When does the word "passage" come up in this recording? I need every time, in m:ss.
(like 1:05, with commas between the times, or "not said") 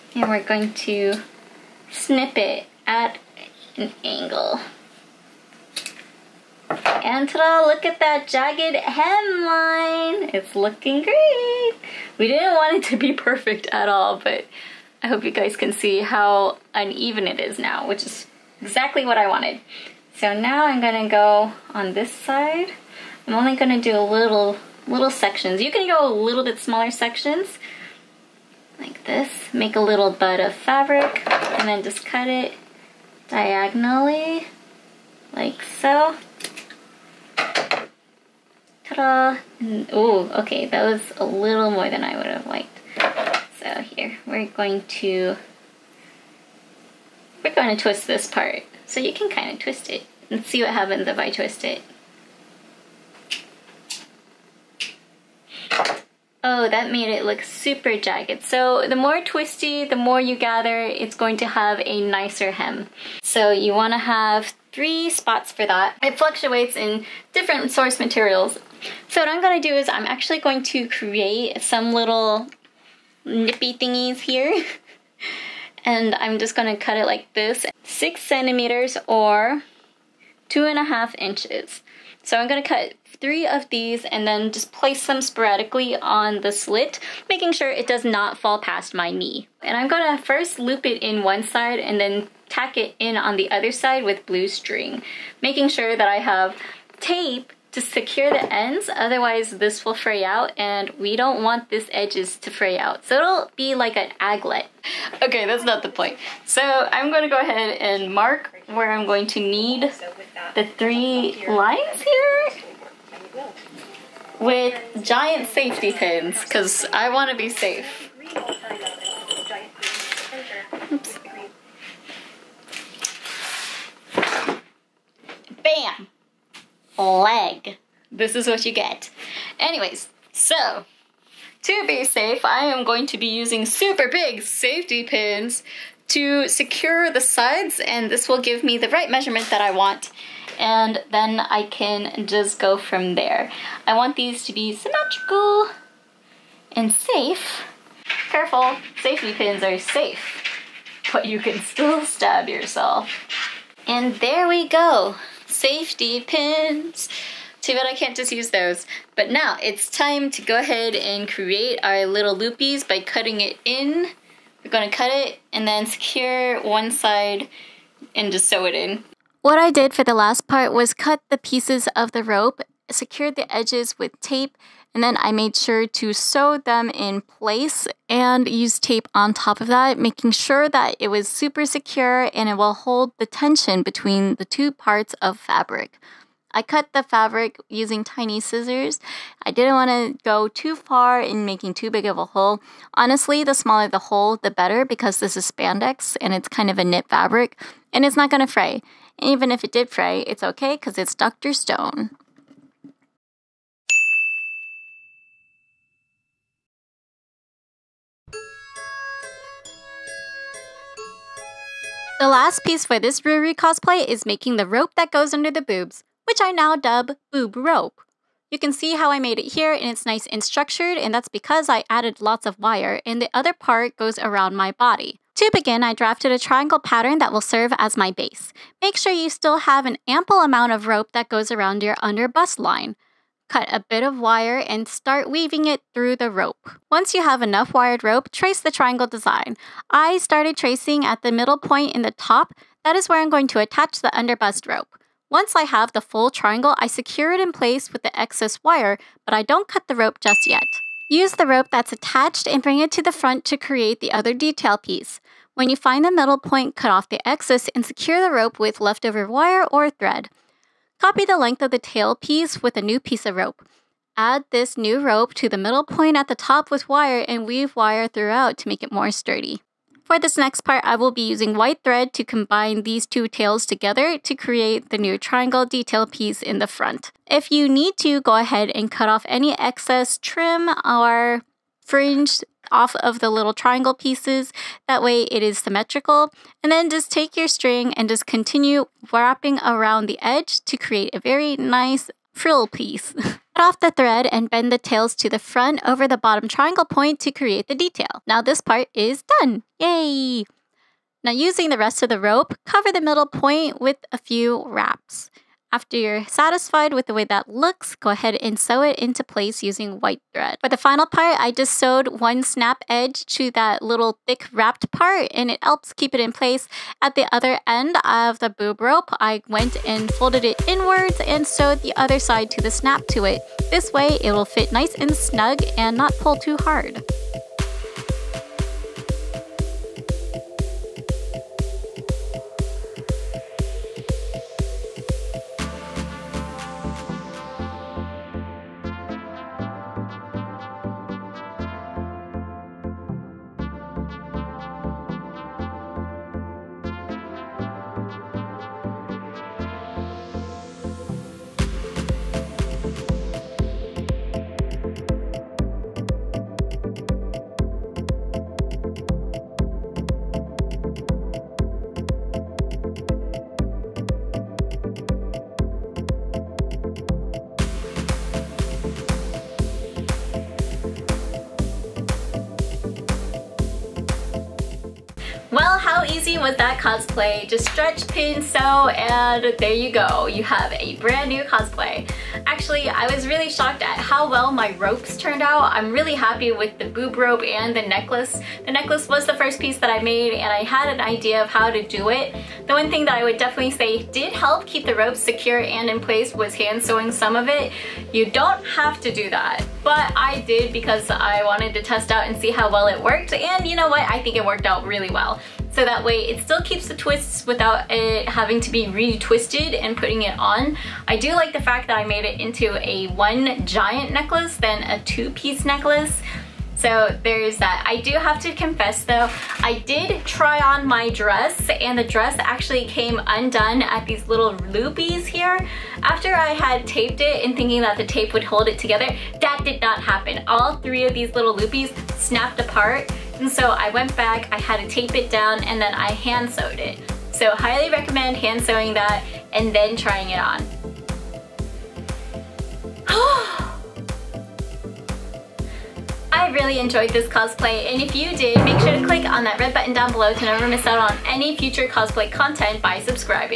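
not said.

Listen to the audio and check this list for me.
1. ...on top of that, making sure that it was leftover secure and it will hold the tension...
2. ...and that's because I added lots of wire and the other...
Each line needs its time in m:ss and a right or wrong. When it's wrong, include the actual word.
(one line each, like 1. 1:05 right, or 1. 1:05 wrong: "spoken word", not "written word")
1. 2:59 wrong: "super", not "leftover"
2. 3:40 right.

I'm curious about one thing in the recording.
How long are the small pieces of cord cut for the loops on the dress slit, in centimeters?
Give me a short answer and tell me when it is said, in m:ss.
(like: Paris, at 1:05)
6 centimeters, at 1:17.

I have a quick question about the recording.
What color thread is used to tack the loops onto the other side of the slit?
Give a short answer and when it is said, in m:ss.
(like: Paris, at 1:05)
Blue, at 1:34.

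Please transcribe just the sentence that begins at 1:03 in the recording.
So you want to have three spots for that.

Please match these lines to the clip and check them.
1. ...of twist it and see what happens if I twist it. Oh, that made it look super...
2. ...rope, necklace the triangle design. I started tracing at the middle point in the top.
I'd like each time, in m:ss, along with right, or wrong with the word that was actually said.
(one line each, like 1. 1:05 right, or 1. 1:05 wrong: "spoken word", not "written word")
1. 0:49 right
2. 3:58 wrong: "trace", not "necklace".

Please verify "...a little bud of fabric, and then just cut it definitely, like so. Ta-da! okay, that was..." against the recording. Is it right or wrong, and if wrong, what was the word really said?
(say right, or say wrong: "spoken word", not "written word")
wrong: "diagonally", not "definitely".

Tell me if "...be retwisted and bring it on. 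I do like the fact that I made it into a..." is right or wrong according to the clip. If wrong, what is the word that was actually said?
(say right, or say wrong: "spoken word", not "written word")
wrong: "putting", not "bring".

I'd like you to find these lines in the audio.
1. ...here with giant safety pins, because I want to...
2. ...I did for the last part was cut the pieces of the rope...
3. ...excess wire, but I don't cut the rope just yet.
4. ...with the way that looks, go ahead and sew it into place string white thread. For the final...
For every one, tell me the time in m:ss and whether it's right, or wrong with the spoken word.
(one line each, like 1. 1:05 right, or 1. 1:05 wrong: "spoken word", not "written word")
1. 1:52 right
2. 2:49 right
3. 4:08 right
4. 5:06 wrong: "using", not "string".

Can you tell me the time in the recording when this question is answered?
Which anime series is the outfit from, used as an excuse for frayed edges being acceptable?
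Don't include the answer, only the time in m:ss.
3:21.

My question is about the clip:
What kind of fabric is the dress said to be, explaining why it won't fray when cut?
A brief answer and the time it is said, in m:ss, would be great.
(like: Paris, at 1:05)
Spandex, at 3:15.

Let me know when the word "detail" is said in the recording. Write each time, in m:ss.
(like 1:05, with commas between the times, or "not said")
4:14, 4:35, 4:57.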